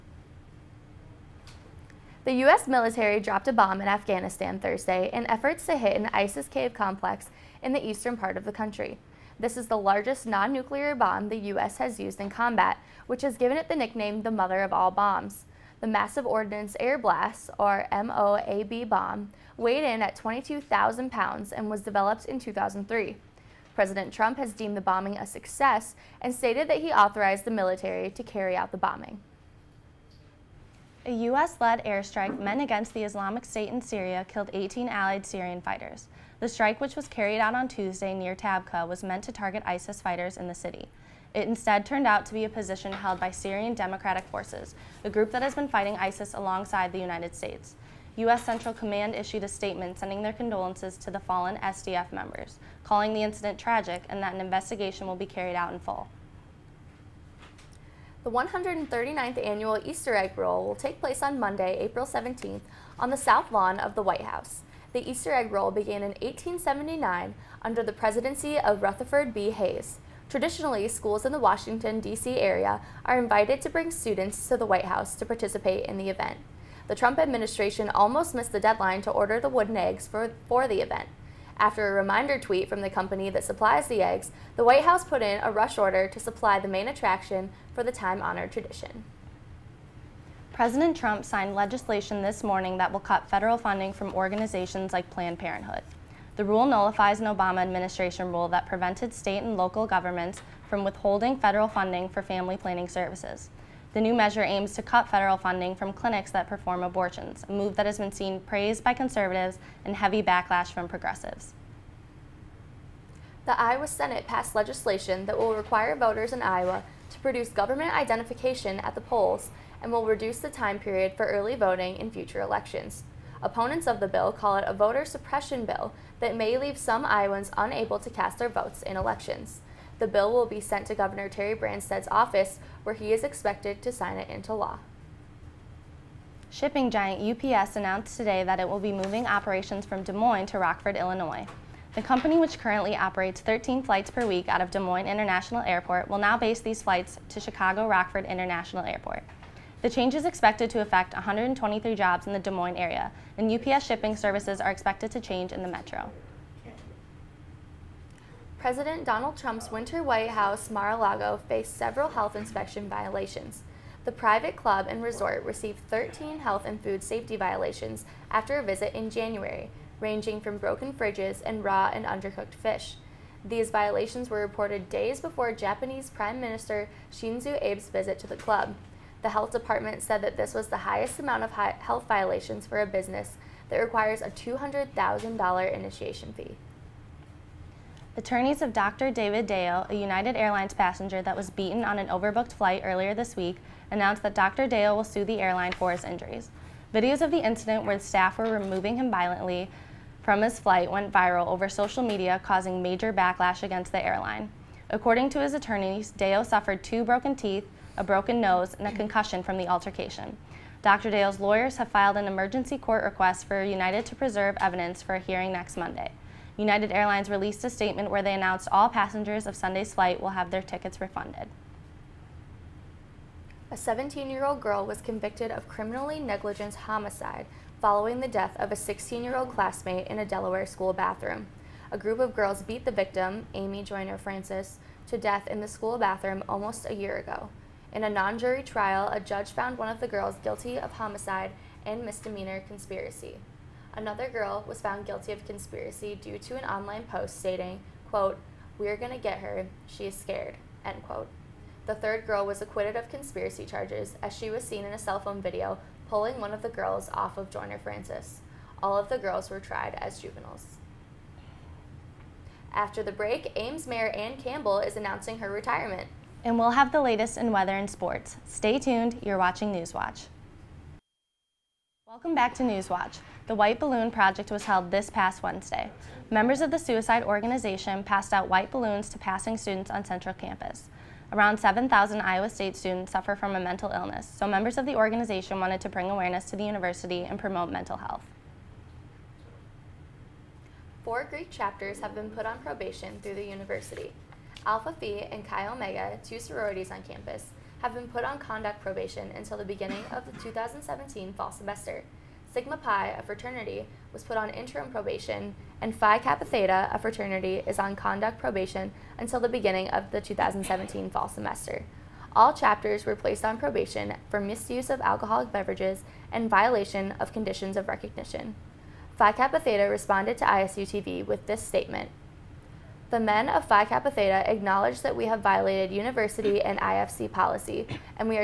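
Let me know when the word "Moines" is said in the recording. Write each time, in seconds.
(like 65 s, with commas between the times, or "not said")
140 s, 144 s, 152 s.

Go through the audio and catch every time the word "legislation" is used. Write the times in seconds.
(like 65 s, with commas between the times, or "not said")
91 s, 114 s.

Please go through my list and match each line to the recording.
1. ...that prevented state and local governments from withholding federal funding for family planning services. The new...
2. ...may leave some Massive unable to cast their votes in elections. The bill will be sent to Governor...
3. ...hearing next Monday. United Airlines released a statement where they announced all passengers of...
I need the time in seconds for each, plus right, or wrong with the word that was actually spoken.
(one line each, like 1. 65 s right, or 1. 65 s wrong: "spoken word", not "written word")
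1. 98 s right
2. 126 s wrong: "Iowans", not "Massive"
3. 215 s right.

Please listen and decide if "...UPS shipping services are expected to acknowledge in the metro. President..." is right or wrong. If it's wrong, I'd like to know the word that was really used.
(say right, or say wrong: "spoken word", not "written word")
wrong: "change", not "acknowledge".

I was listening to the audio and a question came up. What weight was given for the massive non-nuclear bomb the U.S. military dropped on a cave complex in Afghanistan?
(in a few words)
22,000 pounds.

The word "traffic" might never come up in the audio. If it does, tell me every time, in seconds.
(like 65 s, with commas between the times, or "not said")
not said.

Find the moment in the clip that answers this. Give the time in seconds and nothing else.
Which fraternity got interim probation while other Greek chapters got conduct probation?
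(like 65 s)
302 s.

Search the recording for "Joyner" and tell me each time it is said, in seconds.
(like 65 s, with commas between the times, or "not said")
233 s, 257 s.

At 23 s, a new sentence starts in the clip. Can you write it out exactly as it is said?
President Trump has deemed the bombing a success and stated that he authorized the military to carry out the bombing.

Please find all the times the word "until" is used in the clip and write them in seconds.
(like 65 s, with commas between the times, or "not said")
299 s, 309 s.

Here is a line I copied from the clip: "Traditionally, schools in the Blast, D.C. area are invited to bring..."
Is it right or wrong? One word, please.
wrong.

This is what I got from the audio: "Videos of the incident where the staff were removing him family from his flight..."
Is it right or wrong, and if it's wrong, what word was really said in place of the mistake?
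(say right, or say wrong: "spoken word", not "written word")
wrong: "violently", not "family".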